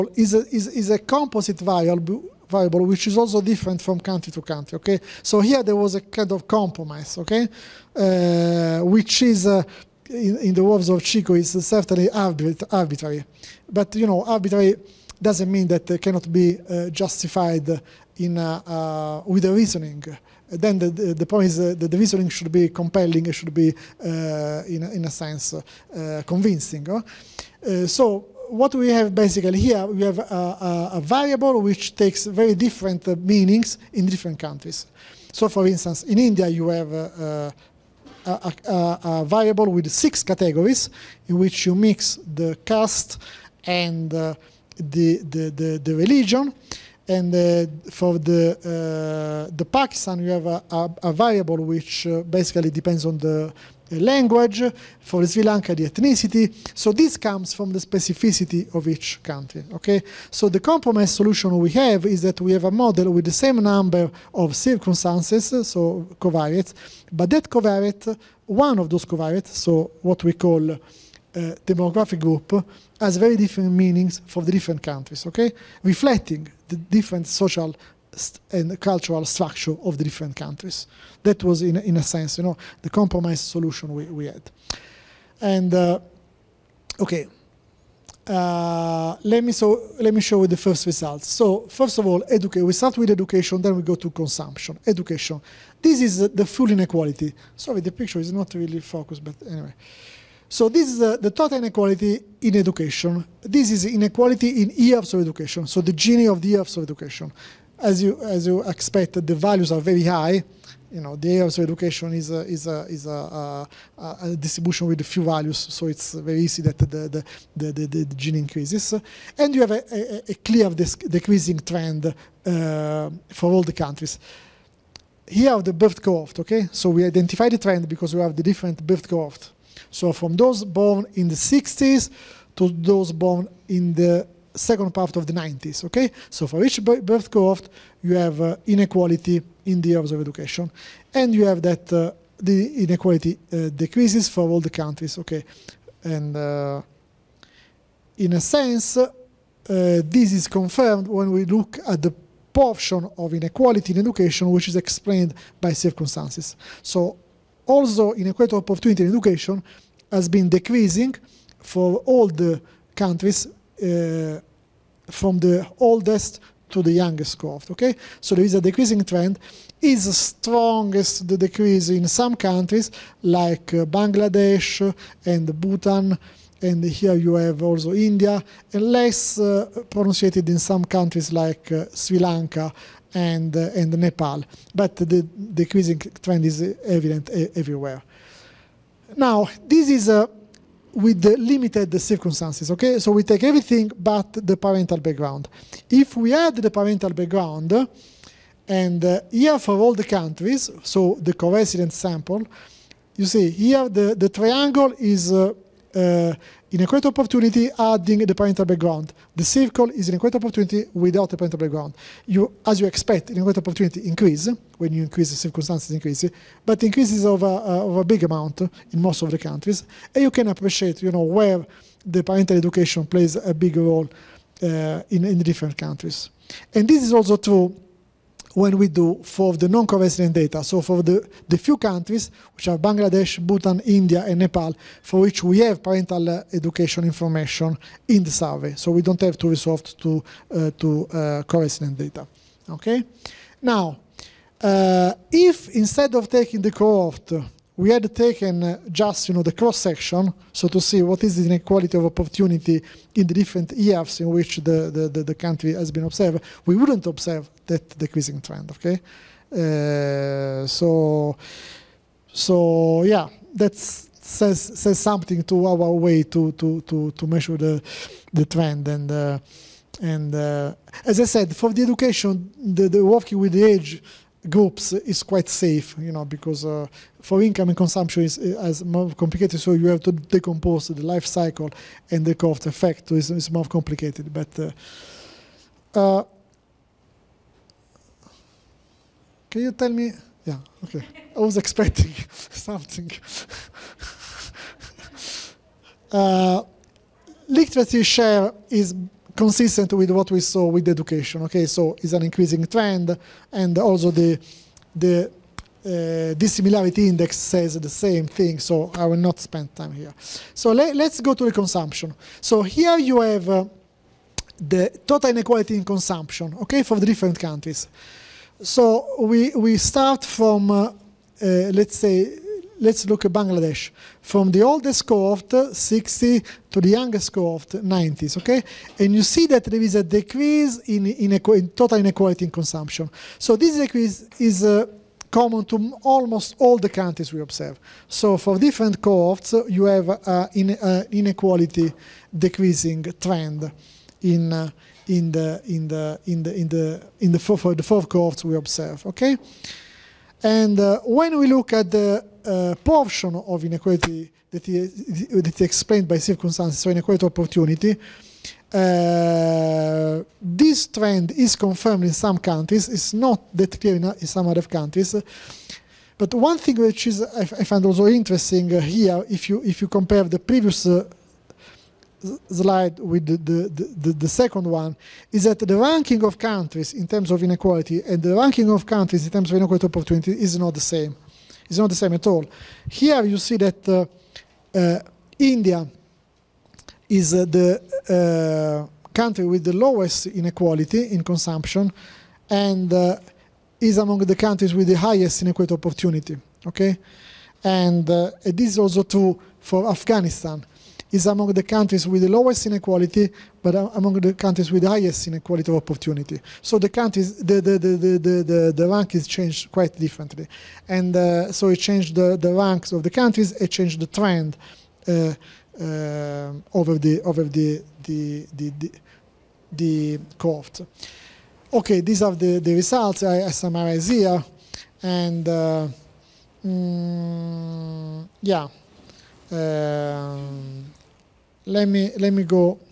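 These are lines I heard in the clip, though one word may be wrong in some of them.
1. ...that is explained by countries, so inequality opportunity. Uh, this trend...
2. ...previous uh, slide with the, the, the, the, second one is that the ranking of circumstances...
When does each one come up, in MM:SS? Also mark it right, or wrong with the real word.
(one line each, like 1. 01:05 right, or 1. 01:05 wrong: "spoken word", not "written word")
1. 05:55 wrong: "circumstances", not "countries"
2. 06:10 wrong: "countries", not "circumstances".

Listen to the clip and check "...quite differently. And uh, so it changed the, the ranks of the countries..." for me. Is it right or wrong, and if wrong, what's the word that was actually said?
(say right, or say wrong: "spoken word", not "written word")
right.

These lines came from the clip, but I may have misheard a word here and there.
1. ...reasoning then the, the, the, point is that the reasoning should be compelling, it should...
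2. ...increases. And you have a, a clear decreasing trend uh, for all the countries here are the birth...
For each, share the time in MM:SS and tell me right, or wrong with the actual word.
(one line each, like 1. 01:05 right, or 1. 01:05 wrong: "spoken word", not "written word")
1. 00:19 right
2. 01:58 right.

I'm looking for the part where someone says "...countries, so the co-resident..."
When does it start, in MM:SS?
03:20.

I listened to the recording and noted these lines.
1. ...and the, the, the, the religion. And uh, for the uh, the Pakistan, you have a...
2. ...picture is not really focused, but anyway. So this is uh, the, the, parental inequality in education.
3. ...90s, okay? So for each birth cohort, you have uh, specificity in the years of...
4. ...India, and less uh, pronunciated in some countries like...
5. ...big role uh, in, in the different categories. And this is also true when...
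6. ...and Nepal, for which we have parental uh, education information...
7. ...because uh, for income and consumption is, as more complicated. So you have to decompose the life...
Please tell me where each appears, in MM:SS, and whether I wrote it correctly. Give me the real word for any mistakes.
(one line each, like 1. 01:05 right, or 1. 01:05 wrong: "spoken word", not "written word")
1. 00:43 right
2. 01:37 wrong: "total", not "parental"
3. 02:15 wrong: "inequality", not "specificity"
4. 02:57 right
5. 03:43 wrong: "countries", not "categories"
6. 03:54 right
7. 04:36 right.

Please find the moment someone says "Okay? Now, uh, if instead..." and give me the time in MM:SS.
04:02.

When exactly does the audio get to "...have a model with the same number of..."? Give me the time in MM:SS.
01:02.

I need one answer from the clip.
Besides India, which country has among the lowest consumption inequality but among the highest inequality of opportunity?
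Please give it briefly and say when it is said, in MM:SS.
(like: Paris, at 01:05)
Afghanistan, at 06:39.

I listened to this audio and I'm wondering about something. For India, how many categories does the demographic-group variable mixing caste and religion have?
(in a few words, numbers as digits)
6.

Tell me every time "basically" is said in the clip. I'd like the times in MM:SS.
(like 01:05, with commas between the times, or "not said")
00:29, 00:52.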